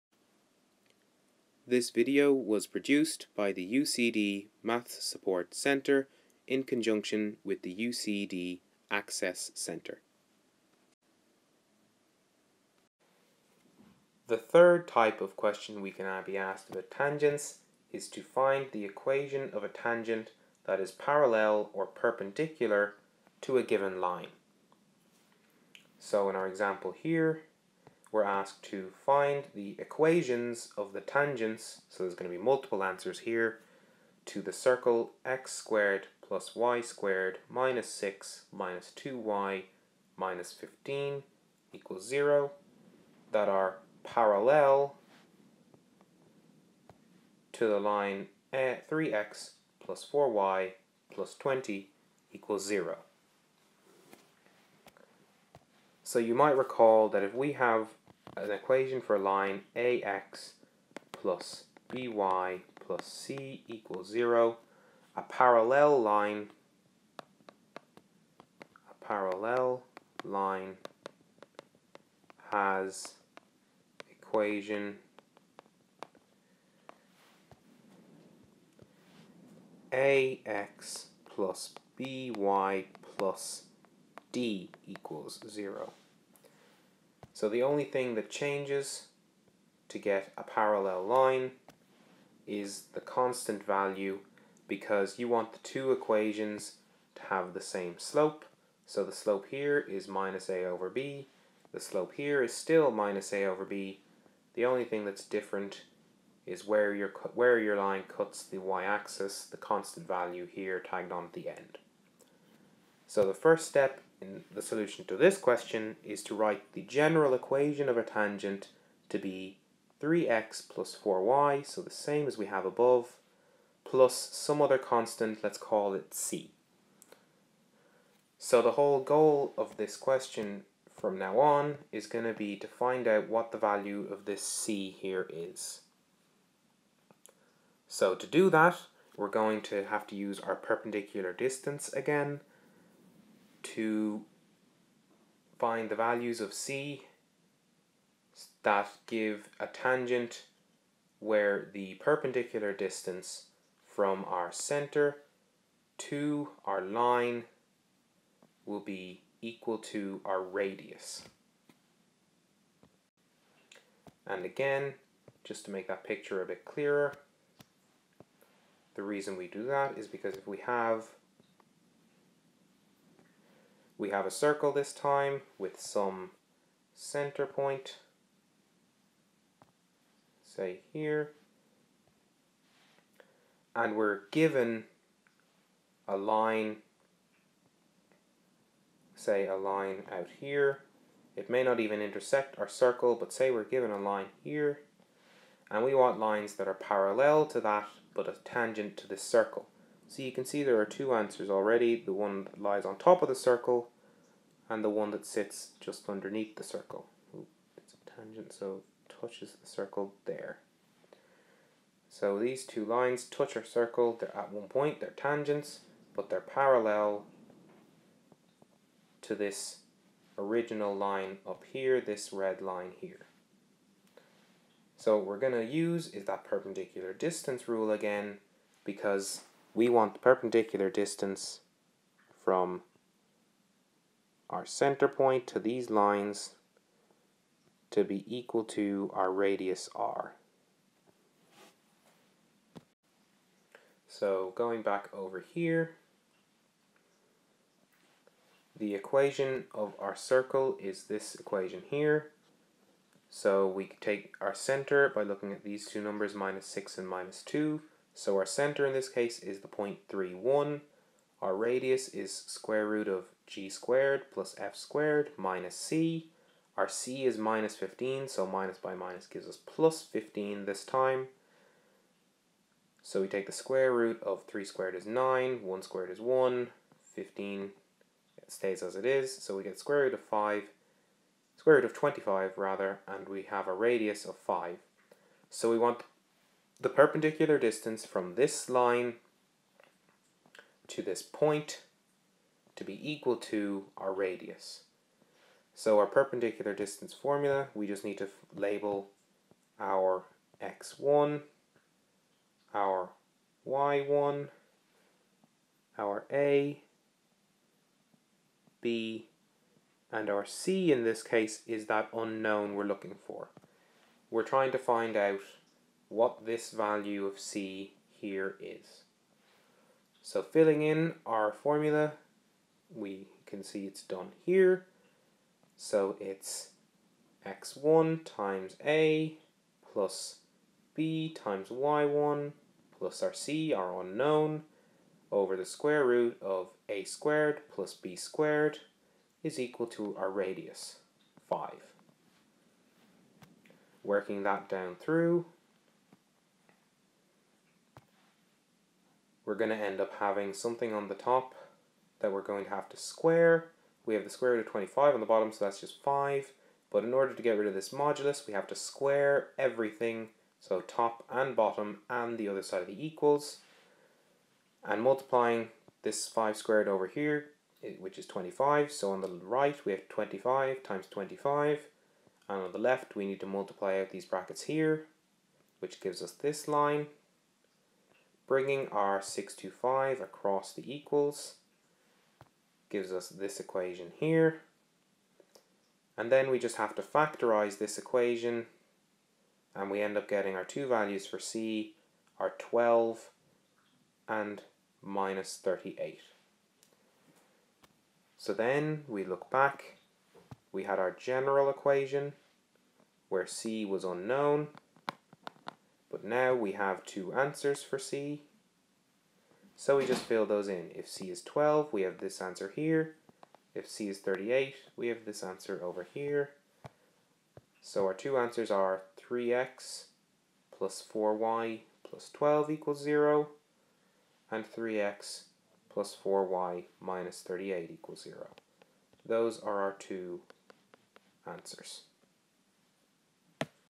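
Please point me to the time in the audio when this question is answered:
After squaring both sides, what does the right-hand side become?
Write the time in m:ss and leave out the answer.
6:10.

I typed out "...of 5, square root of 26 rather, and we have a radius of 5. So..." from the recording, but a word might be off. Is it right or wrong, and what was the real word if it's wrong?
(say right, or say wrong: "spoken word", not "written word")
wrong: "25", not "26".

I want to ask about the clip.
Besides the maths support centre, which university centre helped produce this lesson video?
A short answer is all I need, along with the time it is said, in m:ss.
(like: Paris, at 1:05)
UCD Access Centre, at 0:07.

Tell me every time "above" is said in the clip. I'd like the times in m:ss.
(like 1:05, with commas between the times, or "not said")
2:02.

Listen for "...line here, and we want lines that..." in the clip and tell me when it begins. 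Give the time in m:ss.
3:13.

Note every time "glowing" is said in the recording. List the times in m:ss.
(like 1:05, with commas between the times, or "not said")
not said.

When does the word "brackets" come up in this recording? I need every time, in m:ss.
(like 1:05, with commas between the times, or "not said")
6:14.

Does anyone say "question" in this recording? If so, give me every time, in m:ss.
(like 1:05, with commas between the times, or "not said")
0:15, 1:55, 2:09.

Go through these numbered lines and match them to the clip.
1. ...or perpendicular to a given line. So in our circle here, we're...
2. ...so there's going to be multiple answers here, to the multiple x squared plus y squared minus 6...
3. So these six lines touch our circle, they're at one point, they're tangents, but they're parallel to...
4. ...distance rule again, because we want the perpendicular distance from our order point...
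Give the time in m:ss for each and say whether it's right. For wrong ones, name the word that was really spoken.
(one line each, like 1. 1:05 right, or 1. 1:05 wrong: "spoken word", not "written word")
1. 0:21 wrong: "example", not "circle"
2. 0:31 wrong: "circle", not "multiple"
3. 3:32 wrong: "two", not "six"
4. 3:47 wrong: "center", not "order".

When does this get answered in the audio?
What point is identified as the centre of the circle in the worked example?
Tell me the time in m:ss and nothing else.
4:20.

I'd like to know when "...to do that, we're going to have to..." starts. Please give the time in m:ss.
2:18.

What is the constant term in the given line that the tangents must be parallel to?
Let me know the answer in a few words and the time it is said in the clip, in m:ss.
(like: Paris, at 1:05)
20, at 0:51.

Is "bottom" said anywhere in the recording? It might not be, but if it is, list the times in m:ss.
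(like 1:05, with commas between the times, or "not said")
5:55, 6:01.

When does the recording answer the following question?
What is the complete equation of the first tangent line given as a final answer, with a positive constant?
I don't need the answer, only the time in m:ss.
6:59.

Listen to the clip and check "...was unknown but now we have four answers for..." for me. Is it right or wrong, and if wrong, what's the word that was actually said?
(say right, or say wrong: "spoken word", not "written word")
wrong: "two", not "four".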